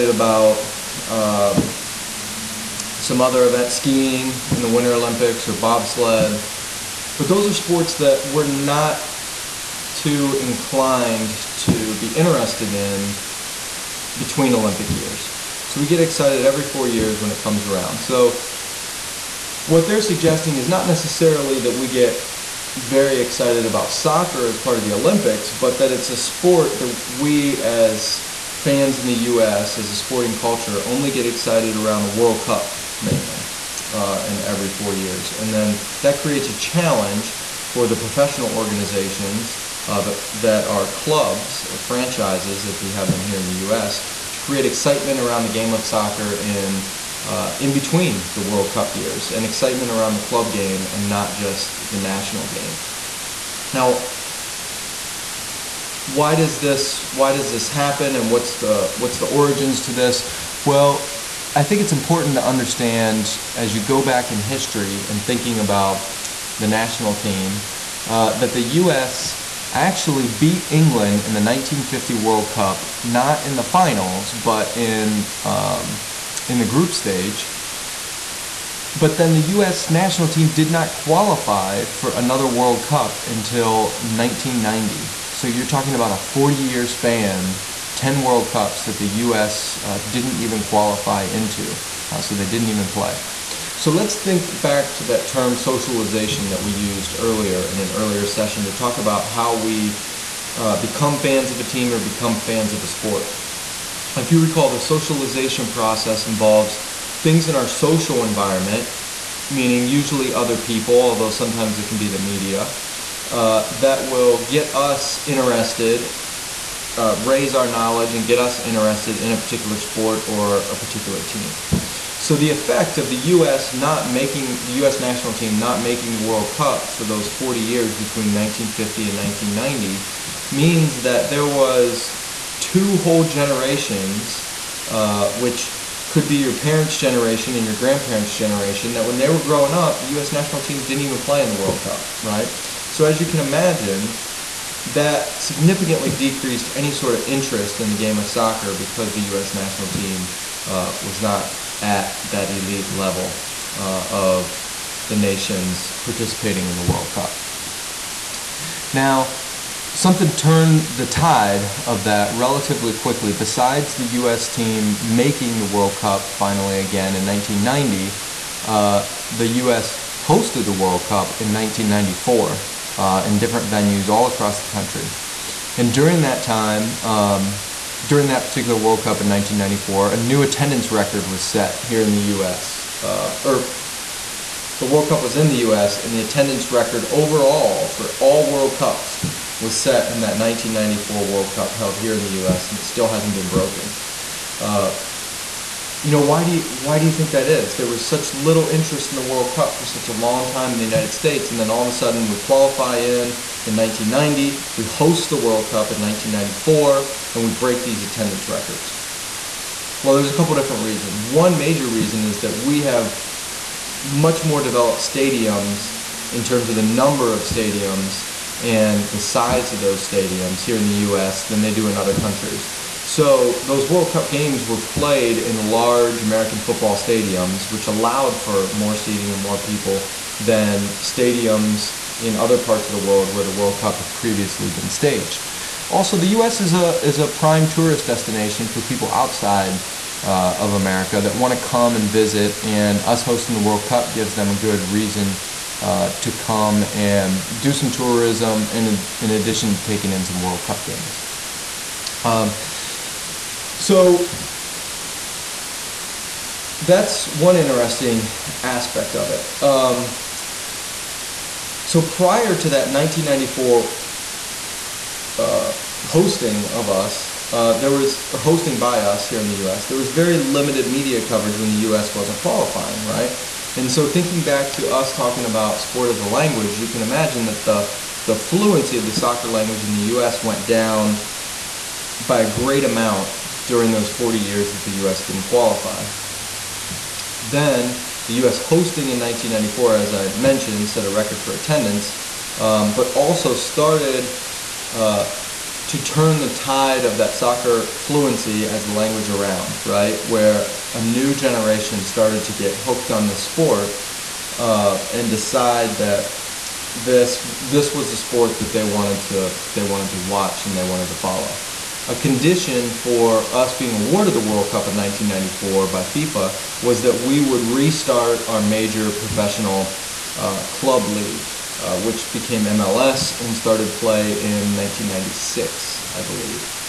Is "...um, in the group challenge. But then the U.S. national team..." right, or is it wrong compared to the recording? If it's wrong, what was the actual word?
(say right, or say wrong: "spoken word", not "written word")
wrong: "stage", not "challenge".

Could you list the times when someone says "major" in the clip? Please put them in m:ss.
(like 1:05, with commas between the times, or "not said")
3:31, 5:18.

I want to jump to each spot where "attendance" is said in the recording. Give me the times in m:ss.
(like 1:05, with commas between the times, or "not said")
3:00, 3:06, 3:28, 4:51.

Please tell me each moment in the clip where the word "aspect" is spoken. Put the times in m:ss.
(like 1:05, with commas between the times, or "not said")
4:18.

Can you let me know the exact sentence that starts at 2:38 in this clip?
Now, something turned the tide of that relatively quickly.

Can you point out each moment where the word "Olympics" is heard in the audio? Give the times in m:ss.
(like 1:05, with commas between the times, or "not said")
0:04, 0:14, 0:24.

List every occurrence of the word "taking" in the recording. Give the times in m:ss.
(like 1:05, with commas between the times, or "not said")
4:09.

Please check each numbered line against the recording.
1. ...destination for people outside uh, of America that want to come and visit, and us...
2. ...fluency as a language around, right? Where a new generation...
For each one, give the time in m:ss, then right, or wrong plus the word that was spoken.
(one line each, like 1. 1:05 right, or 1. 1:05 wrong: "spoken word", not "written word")
1. 3:58 right
2. 4:57 right.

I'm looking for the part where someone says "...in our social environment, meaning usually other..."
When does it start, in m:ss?
1:47.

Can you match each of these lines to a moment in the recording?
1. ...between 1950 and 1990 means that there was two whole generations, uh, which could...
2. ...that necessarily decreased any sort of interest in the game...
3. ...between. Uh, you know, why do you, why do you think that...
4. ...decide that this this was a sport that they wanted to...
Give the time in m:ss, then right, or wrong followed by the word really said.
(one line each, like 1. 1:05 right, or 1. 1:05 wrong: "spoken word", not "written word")
1. 2:07 right
2. 2:24 wrong: "significantly", not "necessarily"
3. 3:13 wrong: "broken", not "between"
4. 5:05 right.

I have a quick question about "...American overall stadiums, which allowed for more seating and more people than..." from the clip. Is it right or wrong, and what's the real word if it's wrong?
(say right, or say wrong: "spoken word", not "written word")
wrong: "football", not "overall".